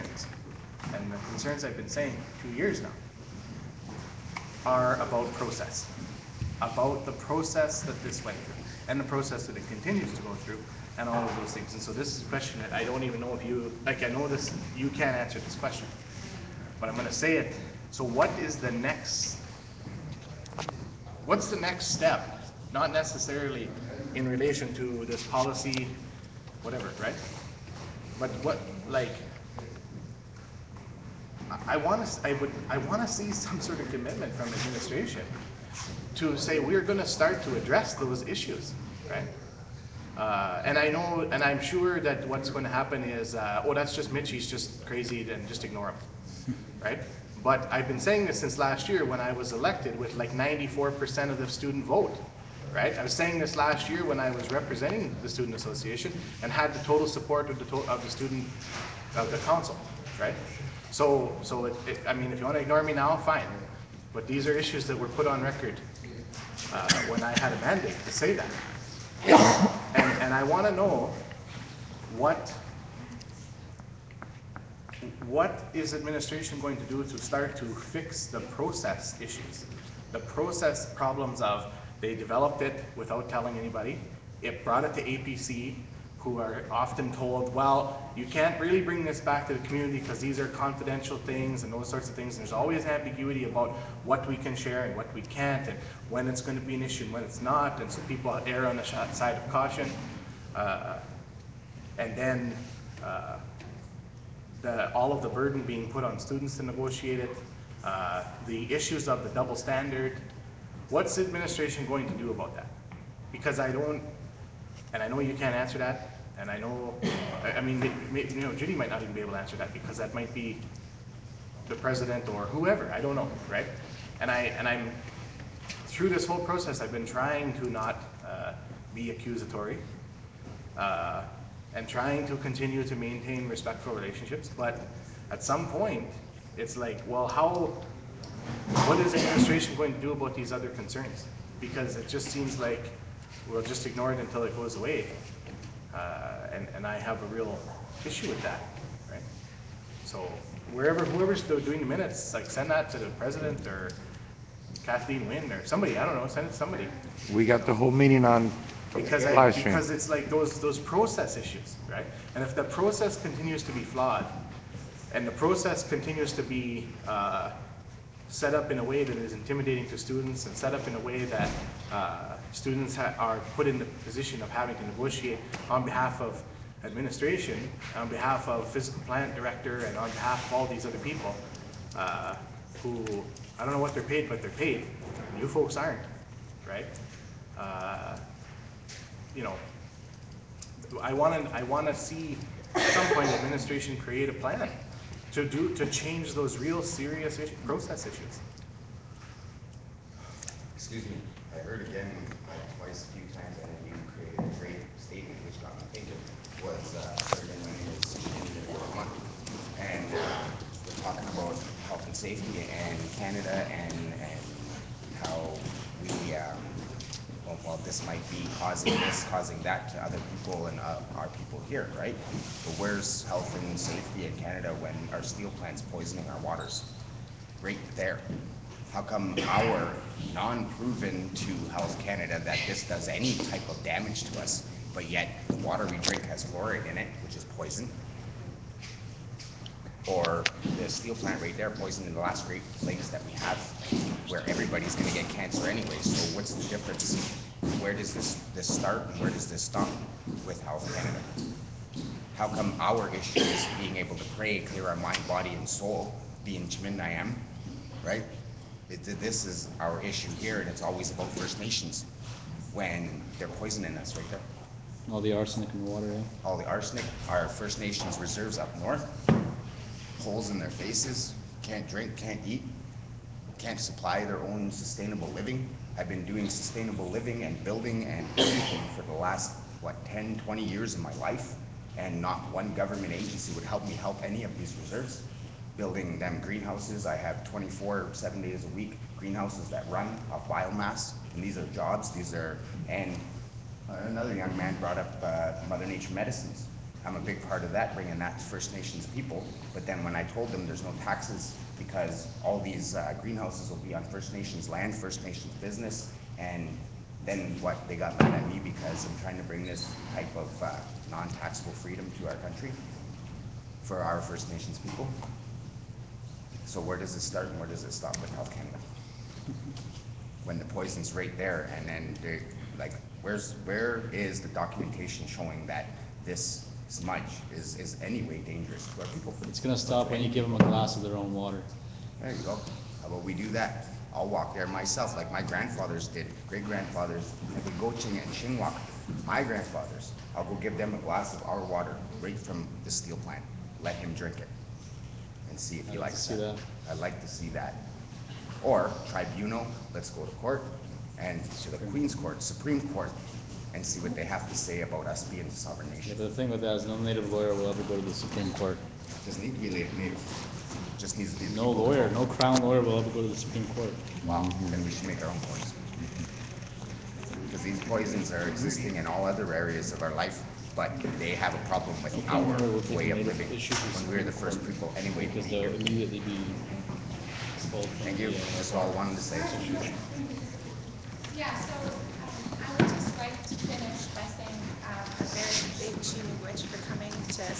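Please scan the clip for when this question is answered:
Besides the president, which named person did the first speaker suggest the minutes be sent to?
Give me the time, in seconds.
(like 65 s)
154 s.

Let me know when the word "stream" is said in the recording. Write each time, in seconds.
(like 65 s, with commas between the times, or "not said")
159 s.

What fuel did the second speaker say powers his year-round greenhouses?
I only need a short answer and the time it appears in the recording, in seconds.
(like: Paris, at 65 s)
Biomass, at 290 s.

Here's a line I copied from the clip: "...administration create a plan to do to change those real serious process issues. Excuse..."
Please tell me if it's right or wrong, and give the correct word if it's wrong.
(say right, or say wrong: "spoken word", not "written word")
right.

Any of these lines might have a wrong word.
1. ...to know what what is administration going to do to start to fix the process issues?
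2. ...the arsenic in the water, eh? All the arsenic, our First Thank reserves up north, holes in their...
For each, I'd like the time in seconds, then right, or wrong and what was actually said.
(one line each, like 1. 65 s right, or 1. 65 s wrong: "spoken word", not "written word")
1. 70 s right
2. 265 s wrong: "Nations", not "Thank".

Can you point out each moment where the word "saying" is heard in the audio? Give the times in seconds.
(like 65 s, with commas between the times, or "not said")
1 s, 47 s, 53 s.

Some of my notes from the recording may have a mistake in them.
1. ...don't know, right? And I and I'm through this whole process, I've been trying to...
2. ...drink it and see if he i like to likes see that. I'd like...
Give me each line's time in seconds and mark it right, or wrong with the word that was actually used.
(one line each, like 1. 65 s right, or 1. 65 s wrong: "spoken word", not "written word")
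1. 123 s right
2. 344 s right.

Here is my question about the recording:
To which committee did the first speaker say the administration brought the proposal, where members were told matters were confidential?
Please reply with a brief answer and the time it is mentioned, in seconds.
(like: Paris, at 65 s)
APC, at 85 s.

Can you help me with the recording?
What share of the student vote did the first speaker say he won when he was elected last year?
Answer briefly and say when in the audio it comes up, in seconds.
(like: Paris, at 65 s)
94%, at 50 s.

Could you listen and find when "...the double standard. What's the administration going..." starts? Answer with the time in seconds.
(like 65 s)
109 s.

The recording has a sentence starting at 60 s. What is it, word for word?
So, so it, it, I mean, if you want to ignore me now, fine.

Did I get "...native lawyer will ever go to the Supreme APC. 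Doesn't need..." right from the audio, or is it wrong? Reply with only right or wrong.
wrong.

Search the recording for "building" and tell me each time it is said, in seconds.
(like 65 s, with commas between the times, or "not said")
277 s, 285 s.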